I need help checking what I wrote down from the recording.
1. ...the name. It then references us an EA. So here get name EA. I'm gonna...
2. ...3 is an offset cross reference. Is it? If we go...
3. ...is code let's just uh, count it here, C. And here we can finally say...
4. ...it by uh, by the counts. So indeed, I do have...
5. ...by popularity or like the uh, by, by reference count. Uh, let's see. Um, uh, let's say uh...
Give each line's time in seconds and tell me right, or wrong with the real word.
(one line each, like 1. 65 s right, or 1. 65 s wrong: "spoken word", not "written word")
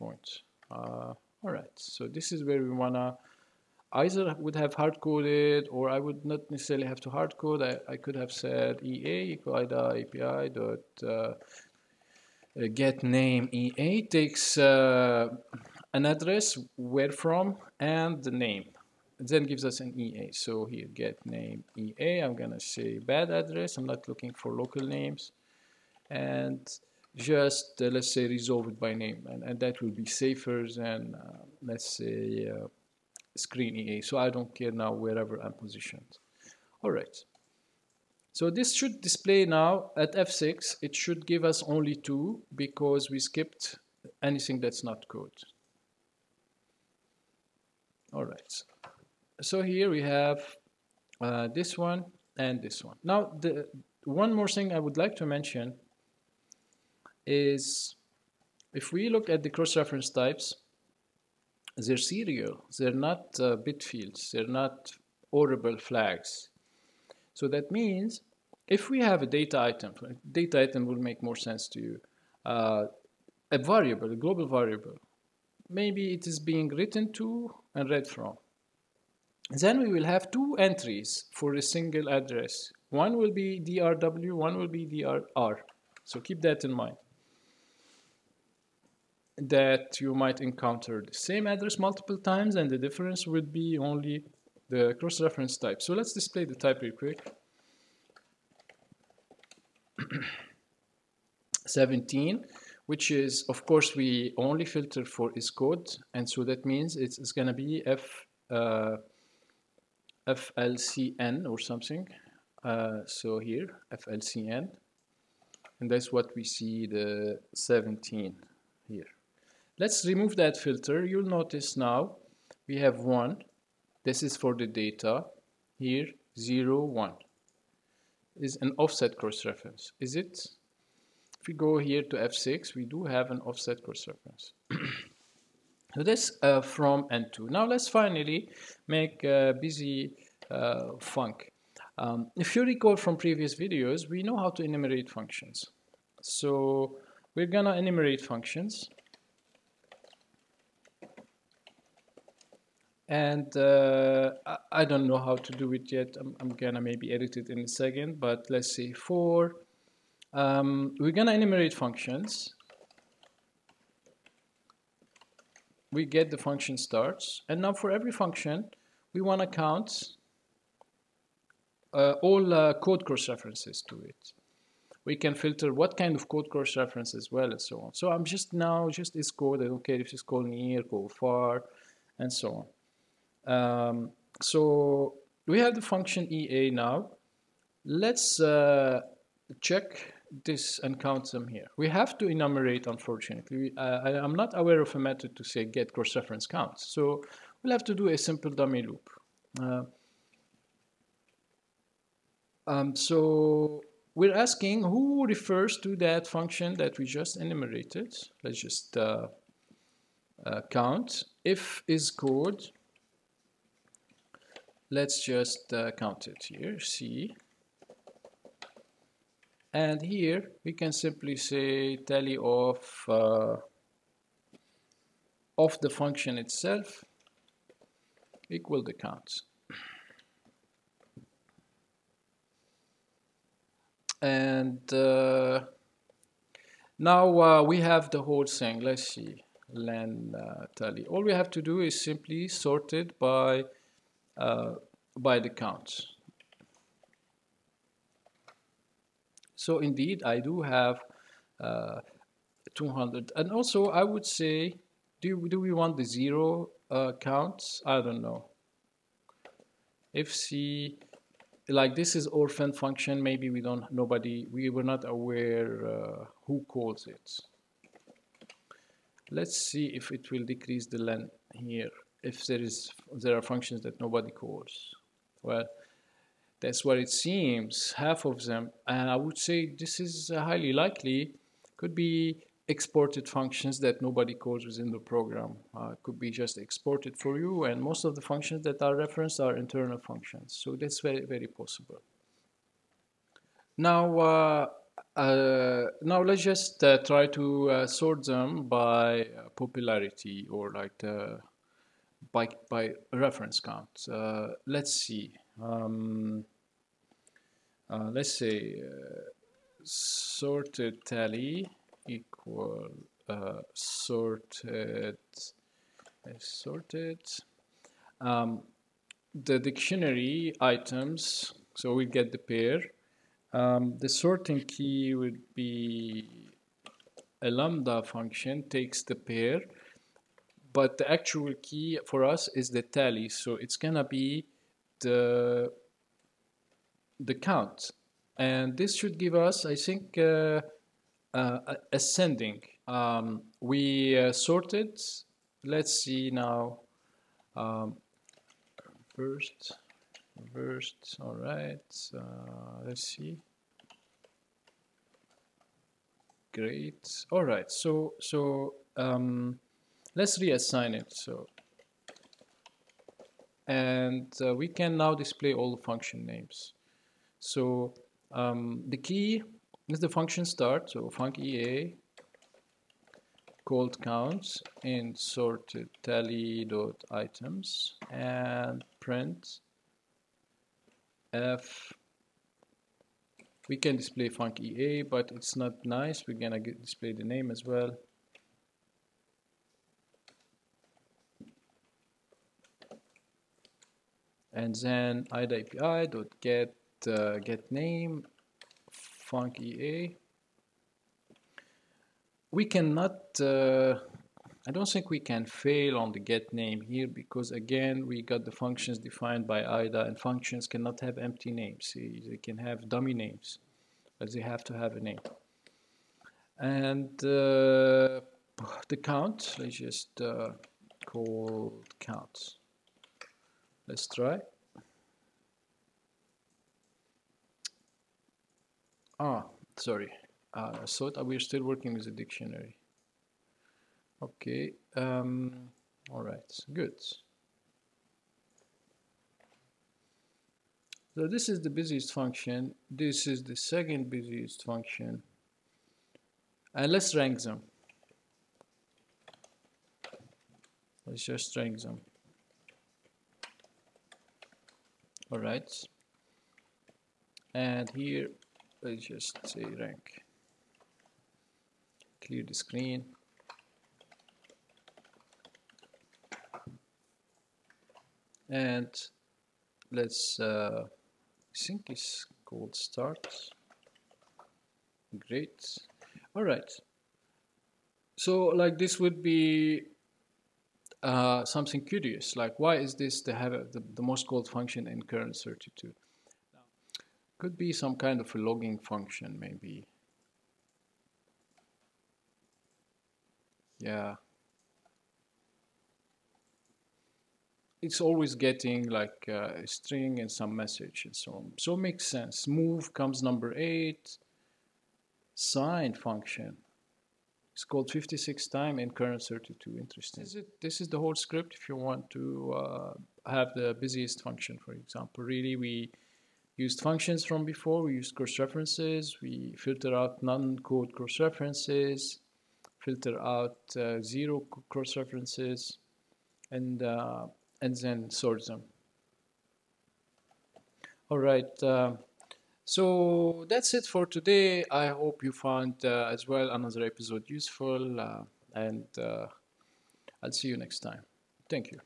1. 18 s wrong: "gives", not "references"
2. 126 s wrong: "1", not "3"
3. 211 s wrong: "simply", not "finally"
4. 242 s right
5. 298 s right.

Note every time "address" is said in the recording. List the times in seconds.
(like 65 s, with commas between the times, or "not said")
16 s, 23 s, 82 s, 91 s.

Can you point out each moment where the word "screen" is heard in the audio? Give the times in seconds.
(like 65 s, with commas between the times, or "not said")
33 s, 462 s.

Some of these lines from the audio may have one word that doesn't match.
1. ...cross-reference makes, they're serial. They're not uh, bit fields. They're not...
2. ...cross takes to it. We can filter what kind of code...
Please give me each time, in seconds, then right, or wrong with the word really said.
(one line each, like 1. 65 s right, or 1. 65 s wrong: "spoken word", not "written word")
1. 59 s wrong: "types", not "makes"
2. 173 s wrong: "references", not "takes".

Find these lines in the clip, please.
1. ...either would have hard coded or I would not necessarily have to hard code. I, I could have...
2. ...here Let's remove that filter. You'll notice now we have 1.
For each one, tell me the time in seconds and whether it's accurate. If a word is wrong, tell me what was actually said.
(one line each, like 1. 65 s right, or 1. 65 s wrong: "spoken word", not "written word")
1. 4 s right
2. 118 s right.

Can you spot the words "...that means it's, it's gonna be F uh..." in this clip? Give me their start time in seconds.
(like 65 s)
106 s.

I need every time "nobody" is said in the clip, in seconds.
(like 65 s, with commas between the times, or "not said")
263 s, 273 s, 284 s.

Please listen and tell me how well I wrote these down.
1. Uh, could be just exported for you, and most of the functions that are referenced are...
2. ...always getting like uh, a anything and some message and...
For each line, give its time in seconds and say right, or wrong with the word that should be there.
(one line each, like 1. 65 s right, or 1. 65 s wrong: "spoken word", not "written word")
1. 285 s right
2. 497 s wrong: "string", not "anything".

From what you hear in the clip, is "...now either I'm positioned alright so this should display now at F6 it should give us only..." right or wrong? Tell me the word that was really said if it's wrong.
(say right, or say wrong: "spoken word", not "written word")
wrong: "wherever", not "either".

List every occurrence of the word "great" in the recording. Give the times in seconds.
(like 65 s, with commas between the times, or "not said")
356 s, 475 s.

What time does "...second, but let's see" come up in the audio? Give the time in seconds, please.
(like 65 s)
157 s.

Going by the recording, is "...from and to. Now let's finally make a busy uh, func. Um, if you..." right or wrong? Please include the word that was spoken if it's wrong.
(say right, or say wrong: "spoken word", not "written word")
right.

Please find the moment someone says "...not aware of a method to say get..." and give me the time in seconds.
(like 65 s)
194 s.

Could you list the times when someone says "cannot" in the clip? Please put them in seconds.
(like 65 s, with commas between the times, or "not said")
402 s, 410 s.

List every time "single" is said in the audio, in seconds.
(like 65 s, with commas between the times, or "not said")
81 s.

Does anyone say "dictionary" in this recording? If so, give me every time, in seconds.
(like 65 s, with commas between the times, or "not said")
319 s, 432 s.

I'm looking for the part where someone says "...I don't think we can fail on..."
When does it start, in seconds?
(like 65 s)
404 s.